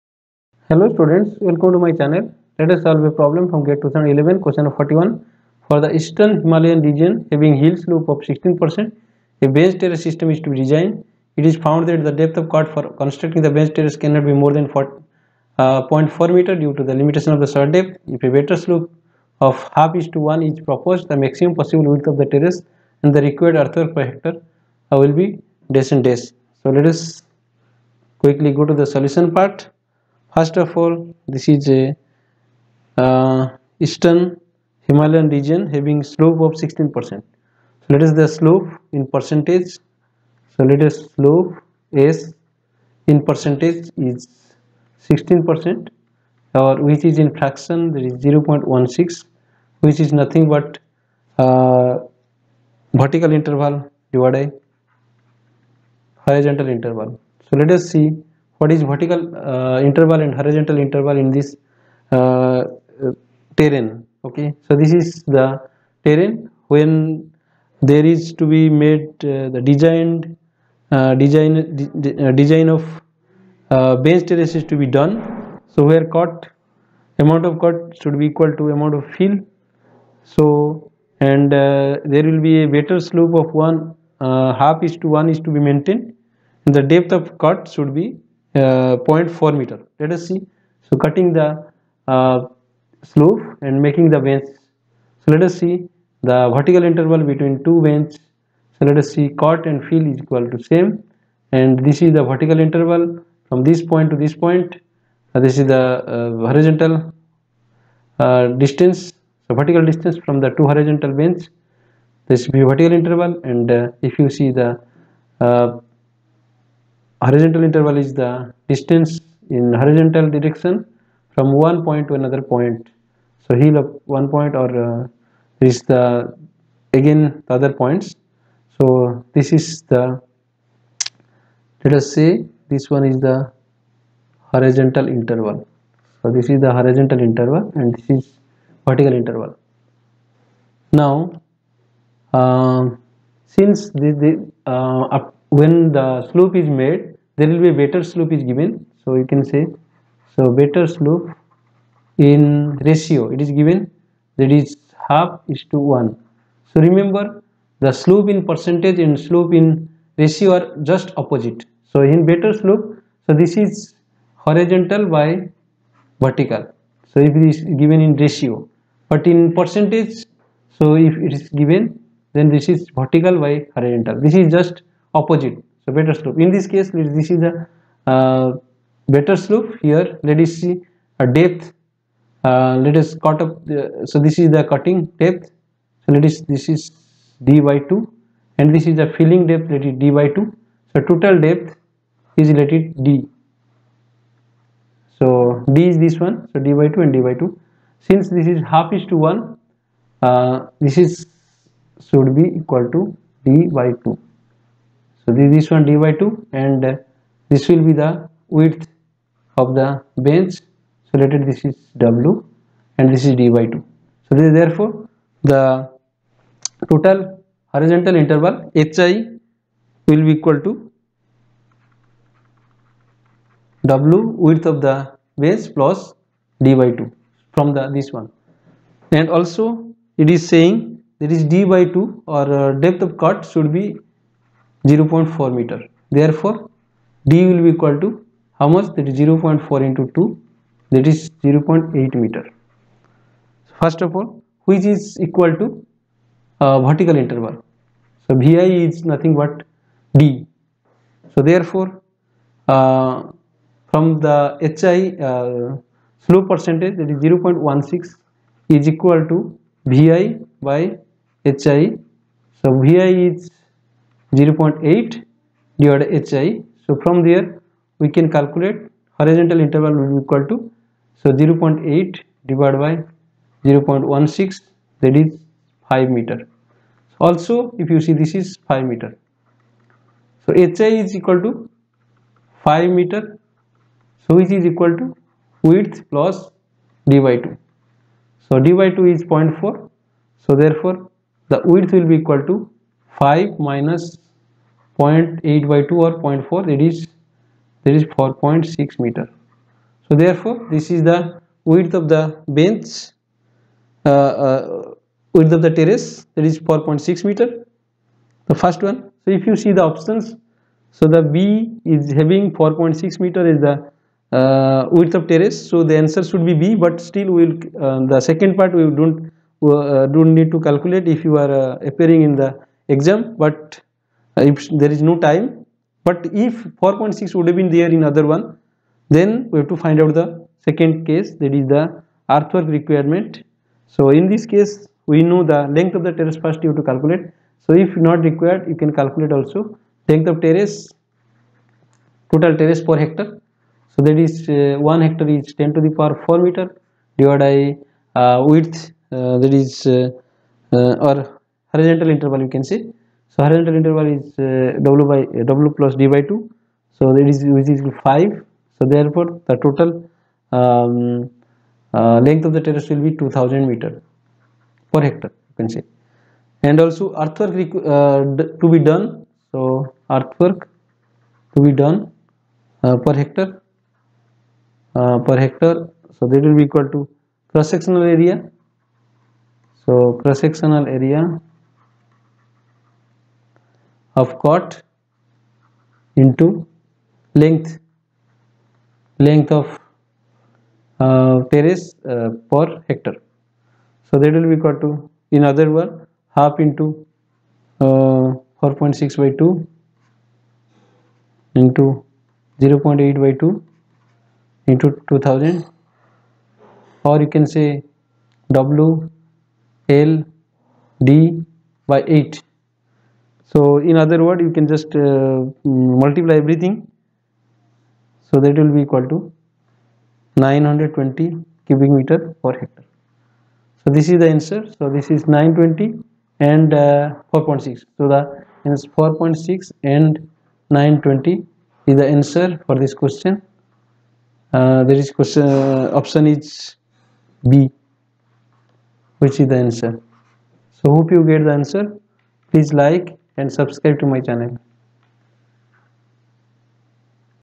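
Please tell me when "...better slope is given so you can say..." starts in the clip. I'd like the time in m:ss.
2:27.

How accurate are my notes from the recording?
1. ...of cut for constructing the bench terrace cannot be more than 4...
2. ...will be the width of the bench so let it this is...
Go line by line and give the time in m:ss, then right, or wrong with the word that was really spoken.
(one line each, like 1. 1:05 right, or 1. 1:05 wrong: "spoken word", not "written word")
1. 0:12 right
2. 3:27 right.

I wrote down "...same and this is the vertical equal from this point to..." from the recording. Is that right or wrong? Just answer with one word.
wrong.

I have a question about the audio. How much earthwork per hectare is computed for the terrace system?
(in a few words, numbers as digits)
920 cubic meter.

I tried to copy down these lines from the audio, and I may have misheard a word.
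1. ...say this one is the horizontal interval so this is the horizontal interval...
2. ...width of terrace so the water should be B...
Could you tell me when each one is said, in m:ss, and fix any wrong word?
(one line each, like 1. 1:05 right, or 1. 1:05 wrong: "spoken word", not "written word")
1. 2:12 right
2. 5:14 wrong: "answer", not "water".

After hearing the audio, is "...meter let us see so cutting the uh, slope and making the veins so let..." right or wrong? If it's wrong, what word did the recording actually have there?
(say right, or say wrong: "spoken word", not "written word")
right.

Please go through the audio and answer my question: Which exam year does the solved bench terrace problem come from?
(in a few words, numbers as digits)
2011.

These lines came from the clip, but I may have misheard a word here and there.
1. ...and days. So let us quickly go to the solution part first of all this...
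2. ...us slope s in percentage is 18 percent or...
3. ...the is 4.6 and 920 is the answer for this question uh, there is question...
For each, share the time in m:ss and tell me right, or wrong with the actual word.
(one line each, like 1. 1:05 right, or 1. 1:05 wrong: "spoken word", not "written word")
1. 0:25 right
2. 0:40 wrong: "16", not "18"
3. 7:08 right.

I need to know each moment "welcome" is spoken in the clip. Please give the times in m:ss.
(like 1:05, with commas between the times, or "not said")
0:01.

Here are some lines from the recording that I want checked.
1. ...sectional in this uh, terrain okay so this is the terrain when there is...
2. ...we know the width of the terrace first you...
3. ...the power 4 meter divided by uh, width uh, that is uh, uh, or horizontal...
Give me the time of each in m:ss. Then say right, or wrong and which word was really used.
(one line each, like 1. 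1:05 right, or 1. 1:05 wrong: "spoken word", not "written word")
1. 1:00 wrong: "interval", not "sectional"
2. 5:35 wrong: "length", not "width"
3. 5:45 right.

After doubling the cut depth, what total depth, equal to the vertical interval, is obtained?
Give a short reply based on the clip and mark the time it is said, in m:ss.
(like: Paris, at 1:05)
0.8 meter, at 4:01.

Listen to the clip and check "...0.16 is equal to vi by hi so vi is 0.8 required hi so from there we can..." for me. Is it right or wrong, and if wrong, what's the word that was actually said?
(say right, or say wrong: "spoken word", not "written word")
wrong: "divided", not "required".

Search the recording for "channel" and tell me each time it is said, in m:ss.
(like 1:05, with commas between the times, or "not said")
0:01, 7:24.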